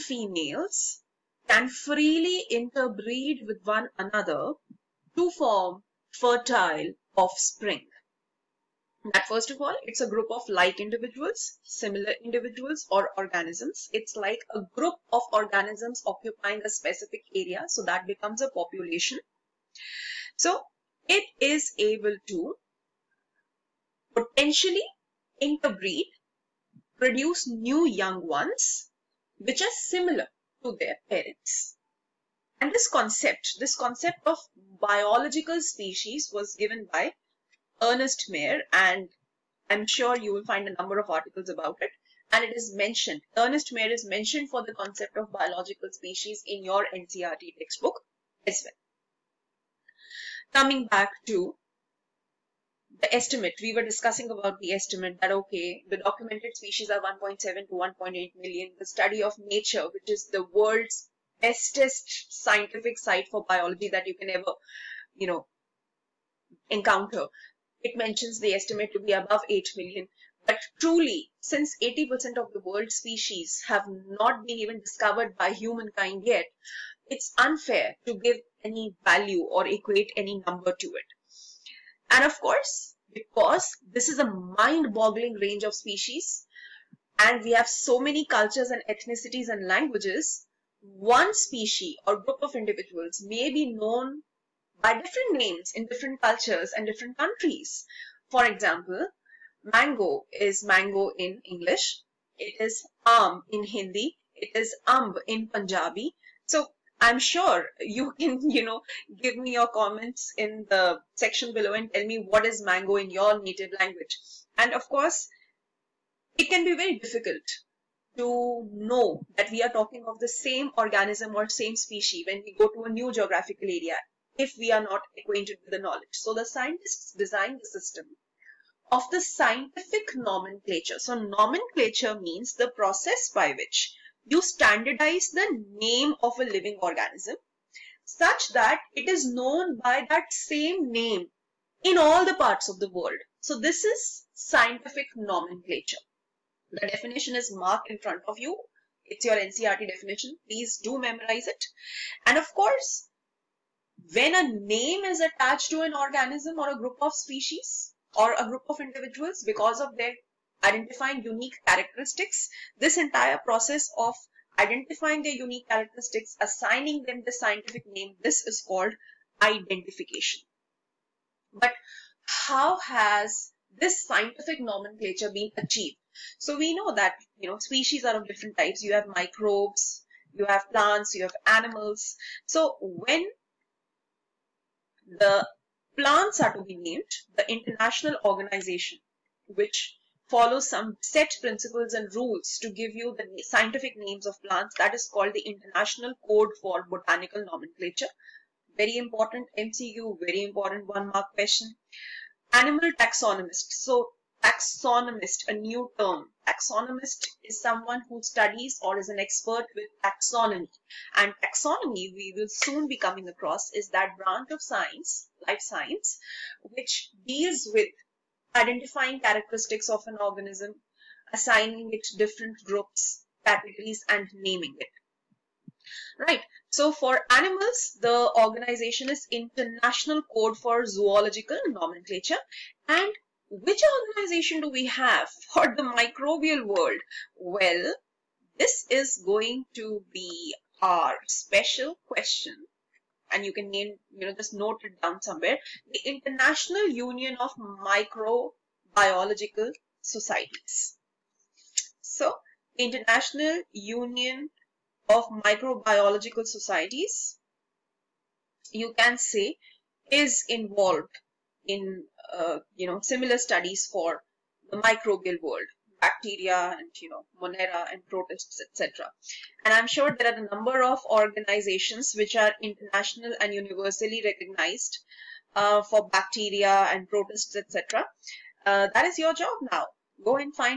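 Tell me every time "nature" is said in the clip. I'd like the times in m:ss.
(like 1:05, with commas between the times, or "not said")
0:59.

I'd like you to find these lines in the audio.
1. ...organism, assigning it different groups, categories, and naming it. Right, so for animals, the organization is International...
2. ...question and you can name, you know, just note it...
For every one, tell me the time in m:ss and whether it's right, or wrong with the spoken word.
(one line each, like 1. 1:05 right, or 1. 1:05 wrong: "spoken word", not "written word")
1. 3:40 right
2. 4:02 right.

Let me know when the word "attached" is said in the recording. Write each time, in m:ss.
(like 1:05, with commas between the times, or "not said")
2:35.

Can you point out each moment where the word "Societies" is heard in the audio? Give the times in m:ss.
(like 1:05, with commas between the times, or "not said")
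4:10, 4:16.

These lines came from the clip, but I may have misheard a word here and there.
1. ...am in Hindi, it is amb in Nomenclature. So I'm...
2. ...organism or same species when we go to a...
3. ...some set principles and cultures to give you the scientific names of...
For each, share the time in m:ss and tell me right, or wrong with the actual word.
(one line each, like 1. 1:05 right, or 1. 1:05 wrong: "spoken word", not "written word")
1. 1:43 wrong: "Punjabi", not "Nomenclature"
2. 2:00 right
3. 3:10 wrong: "rules", not "cultures".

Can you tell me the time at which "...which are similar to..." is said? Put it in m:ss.
0:29.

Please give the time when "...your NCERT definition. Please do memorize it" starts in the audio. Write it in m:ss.
2:29.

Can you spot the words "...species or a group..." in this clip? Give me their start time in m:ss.
2:37.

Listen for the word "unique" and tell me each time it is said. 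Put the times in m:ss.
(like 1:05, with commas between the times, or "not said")
2:41, 2:45.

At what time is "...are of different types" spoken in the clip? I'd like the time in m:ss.
2:58.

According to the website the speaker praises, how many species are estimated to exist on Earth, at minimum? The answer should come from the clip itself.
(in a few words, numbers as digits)
above 8 million.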